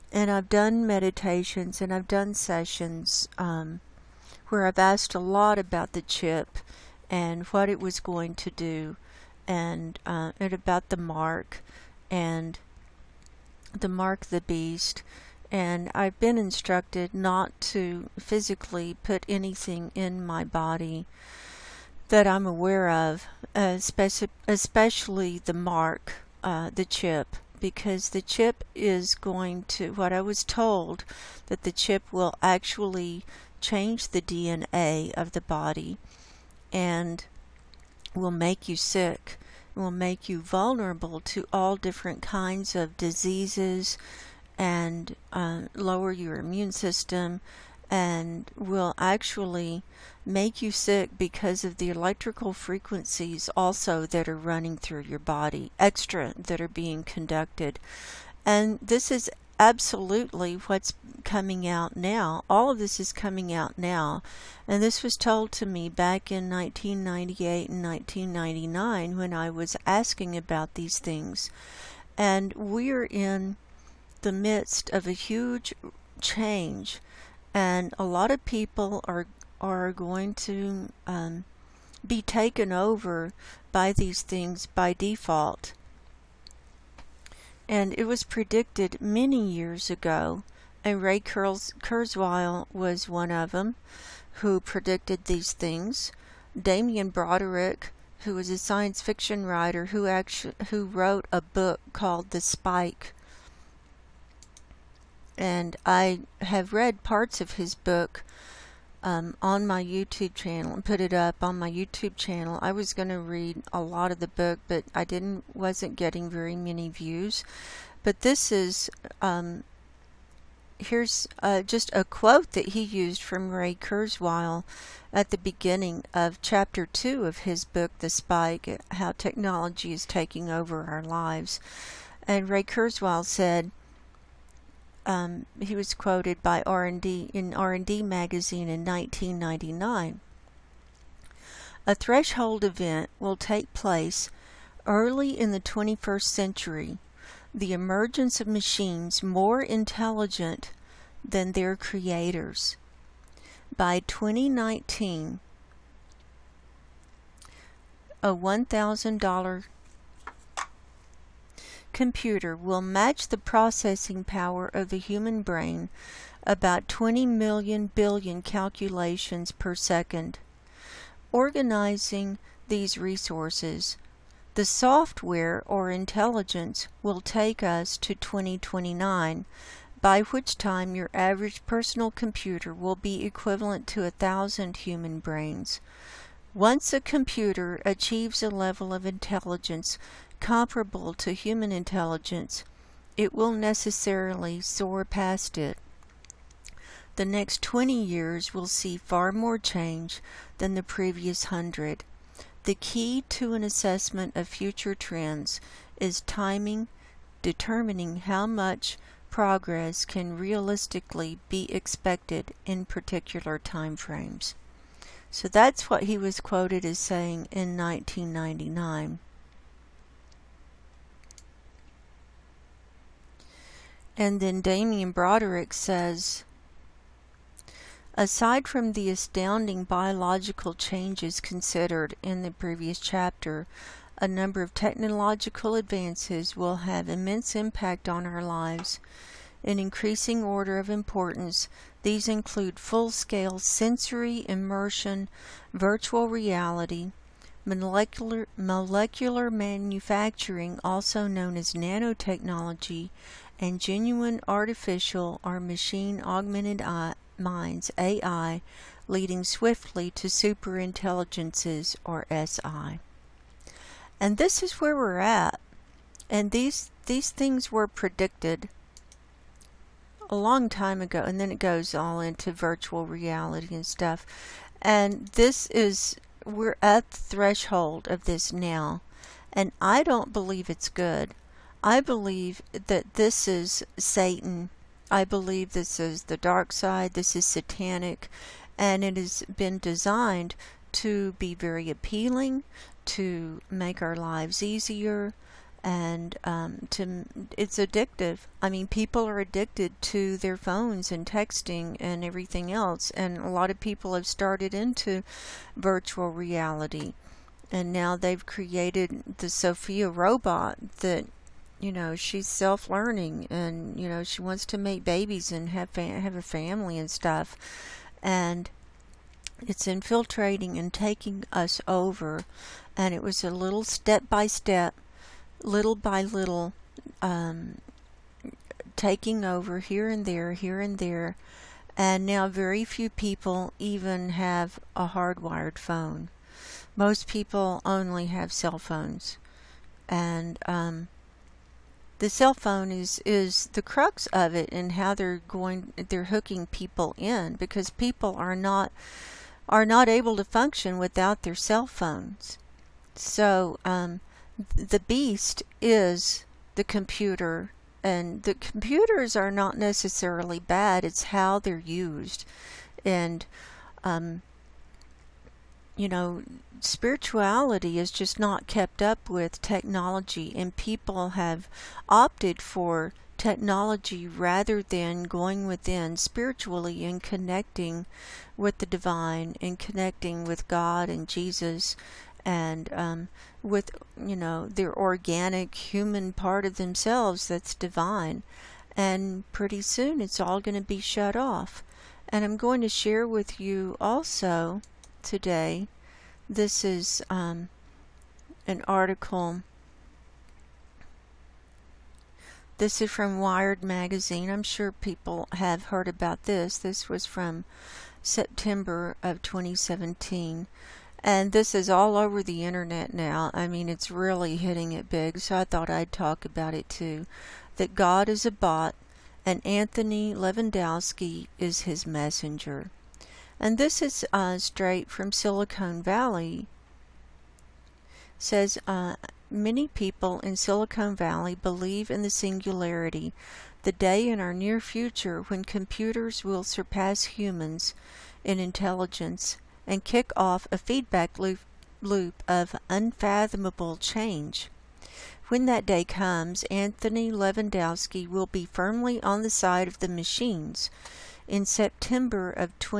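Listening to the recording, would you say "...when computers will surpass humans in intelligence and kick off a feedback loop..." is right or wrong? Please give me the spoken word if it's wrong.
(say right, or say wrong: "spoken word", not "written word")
right.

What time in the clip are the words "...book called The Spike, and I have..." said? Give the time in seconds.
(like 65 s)
101 s.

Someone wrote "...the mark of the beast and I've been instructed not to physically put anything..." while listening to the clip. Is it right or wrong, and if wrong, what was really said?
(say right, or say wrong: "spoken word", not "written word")
right.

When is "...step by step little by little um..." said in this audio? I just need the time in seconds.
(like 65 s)
323 s.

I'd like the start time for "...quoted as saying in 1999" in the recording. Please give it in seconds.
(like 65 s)
216 s.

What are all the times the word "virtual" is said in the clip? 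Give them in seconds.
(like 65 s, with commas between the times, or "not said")
245 s, 272 s, 305 s.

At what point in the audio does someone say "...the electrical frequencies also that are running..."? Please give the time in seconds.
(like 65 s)
51 s.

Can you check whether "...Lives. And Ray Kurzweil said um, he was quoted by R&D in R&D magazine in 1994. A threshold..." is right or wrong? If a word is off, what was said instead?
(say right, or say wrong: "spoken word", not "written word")
wrong: "1999", not "1994".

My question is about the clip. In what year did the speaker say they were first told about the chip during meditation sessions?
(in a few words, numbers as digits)
1998.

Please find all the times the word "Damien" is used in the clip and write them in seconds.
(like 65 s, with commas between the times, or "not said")
96 s, 224 s.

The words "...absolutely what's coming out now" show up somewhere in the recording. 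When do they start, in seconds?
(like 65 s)
59 s.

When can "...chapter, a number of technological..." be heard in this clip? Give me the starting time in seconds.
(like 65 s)
232 s.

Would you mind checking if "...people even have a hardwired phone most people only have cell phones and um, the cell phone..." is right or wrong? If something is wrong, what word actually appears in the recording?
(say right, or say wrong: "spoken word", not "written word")
right.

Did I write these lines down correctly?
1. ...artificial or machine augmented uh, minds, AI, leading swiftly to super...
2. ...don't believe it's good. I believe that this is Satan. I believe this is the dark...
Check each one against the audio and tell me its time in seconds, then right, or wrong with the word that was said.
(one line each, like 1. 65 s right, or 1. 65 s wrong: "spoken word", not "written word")
1. 254 s right
2. 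280 s right.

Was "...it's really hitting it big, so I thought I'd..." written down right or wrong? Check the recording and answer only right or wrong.
right.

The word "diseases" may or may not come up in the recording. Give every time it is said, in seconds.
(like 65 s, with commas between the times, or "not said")
42 s.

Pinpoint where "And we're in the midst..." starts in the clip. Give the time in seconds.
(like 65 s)
72 s.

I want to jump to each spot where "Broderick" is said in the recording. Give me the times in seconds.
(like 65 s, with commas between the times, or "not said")
97 s, 225 s.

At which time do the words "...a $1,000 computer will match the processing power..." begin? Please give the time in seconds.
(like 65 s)
158 s.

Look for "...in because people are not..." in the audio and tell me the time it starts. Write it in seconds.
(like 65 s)
347 s.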